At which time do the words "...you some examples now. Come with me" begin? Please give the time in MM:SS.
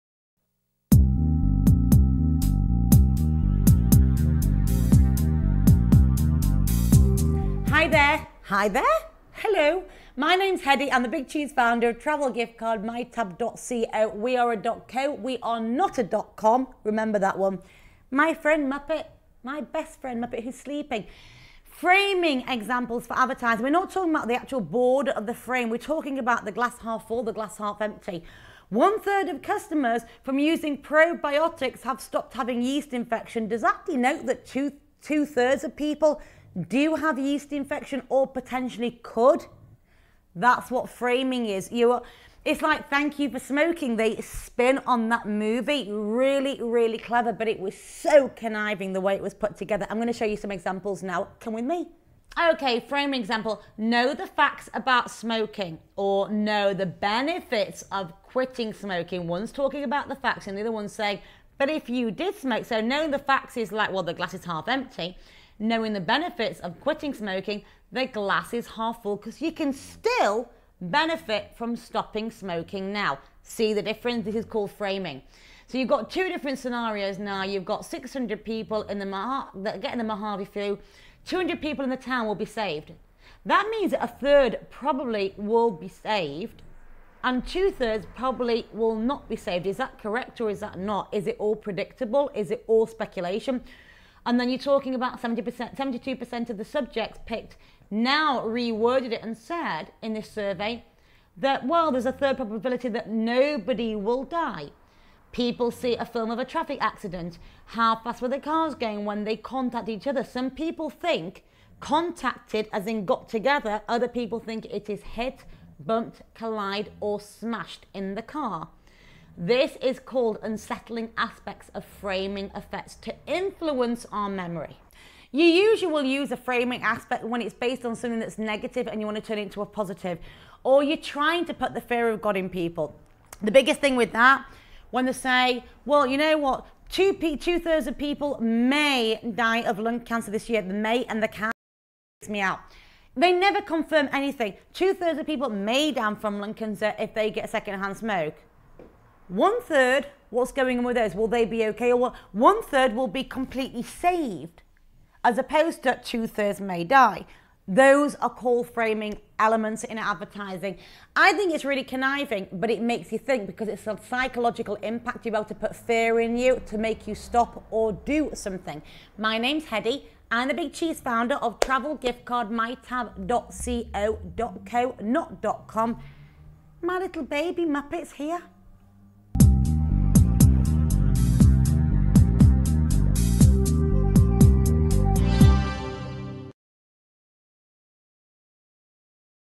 00:50.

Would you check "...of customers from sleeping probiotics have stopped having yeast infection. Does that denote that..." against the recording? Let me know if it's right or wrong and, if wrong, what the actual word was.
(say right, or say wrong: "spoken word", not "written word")
wrong: "using", not "sleeping".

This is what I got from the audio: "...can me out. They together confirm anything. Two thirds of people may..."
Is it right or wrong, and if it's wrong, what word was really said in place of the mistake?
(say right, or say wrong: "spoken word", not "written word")
wrong: "never", not "together".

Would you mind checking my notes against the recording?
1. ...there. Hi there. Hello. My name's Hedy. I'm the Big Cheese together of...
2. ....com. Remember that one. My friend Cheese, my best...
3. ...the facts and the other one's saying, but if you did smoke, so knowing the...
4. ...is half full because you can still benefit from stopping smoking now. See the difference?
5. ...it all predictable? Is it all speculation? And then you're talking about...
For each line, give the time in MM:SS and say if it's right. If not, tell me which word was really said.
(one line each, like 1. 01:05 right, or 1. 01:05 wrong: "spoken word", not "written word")
1. 00:07 wrong: "founder", not "together"
2. 00:16 wrong: "Muppet", not "Cheese"
3. 01:00 right
4. 01:08 right
5. 01:31 right.